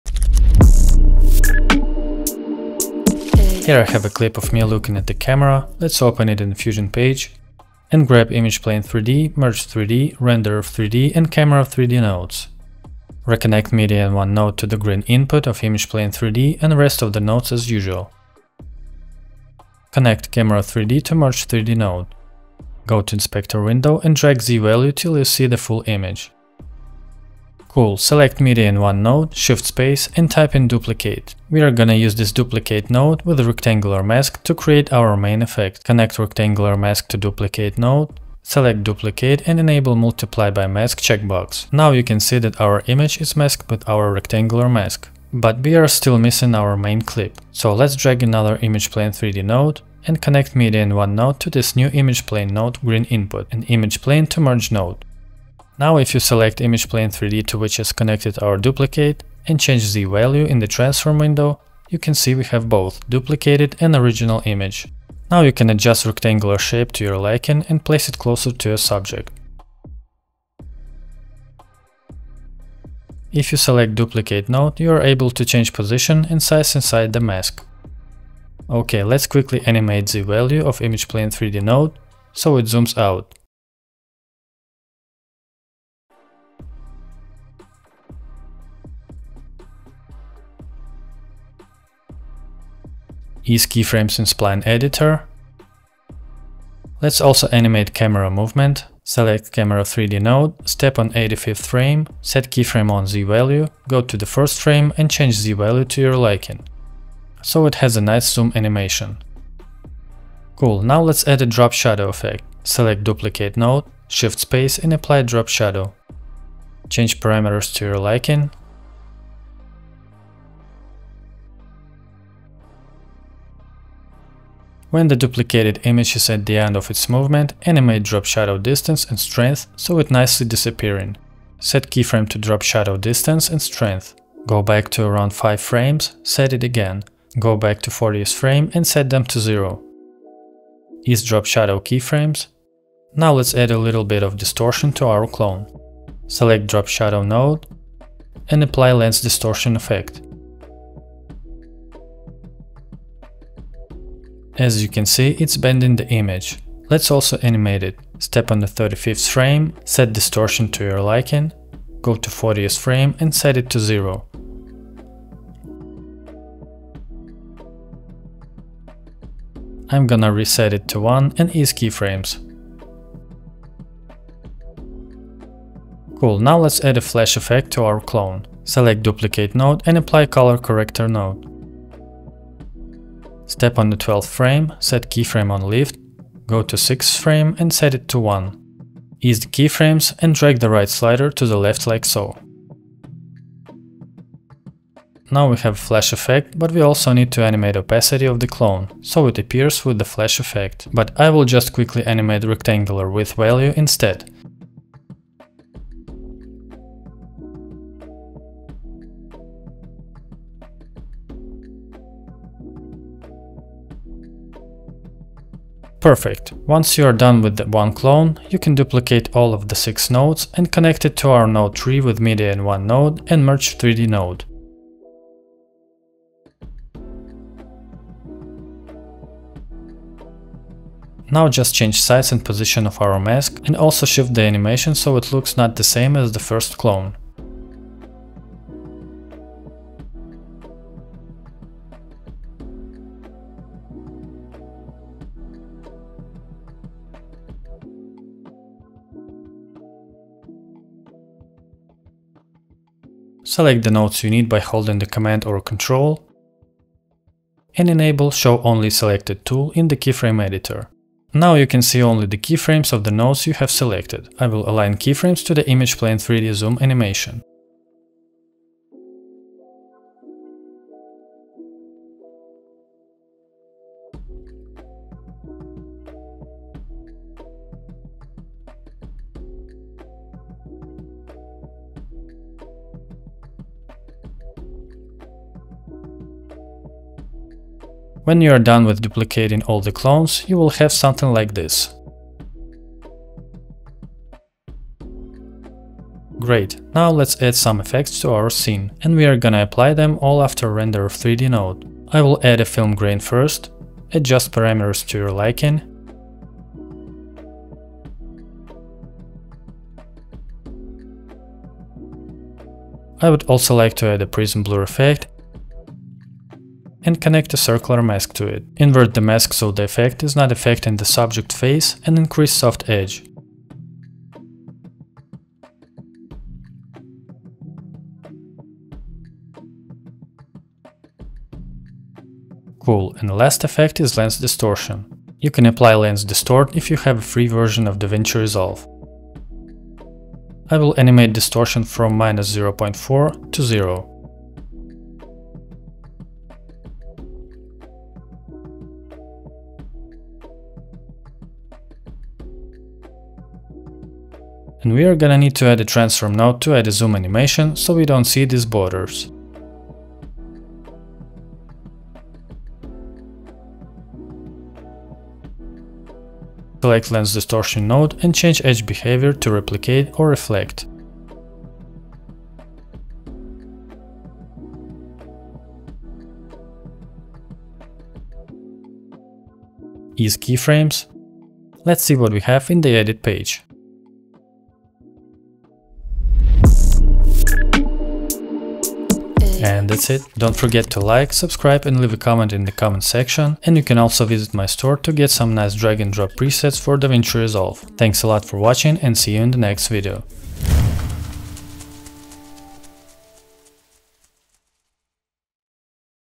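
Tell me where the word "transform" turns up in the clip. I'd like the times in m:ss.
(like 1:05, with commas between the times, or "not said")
1:00, 5:55.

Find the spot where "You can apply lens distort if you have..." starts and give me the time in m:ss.
5:35.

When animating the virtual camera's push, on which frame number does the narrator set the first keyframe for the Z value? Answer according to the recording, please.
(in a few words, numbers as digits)
85.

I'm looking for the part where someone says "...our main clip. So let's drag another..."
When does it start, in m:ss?
0:46.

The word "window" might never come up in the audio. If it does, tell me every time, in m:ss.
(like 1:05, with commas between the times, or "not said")
0:23, 1:01.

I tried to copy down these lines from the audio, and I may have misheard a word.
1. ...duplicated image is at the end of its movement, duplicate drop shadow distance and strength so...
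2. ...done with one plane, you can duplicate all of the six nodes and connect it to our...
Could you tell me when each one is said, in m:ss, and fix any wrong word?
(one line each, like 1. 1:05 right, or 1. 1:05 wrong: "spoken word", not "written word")
1. 2:05 wrong: "animate", not "duplicate"
2. 3:37 wrong: "clone", not "plane".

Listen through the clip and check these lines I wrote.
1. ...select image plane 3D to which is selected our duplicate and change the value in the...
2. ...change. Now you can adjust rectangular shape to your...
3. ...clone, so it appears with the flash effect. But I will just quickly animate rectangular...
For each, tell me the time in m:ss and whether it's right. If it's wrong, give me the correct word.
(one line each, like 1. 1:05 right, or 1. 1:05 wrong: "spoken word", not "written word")
1. 0:56 wrong: "connected", not "selected"
2. 1:04 wrong: "image", not "change"
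3. 3:18 right.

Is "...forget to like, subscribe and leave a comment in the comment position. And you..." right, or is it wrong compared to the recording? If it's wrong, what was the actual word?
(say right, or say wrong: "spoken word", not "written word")
wrong: "section", not "position".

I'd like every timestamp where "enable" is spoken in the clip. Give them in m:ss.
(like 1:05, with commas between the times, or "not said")
0:39, 4:17.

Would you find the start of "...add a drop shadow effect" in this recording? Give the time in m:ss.
1:51.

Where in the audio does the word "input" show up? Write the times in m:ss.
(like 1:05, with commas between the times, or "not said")
0:15, 0:53.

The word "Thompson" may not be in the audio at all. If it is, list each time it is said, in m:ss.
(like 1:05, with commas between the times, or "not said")
not said.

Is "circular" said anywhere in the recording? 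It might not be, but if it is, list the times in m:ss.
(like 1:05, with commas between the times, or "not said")
5:17.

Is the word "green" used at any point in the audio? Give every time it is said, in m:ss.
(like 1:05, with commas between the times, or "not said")
0:14, 0:52.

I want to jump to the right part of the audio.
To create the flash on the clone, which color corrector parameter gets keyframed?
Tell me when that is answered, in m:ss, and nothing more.
3:05.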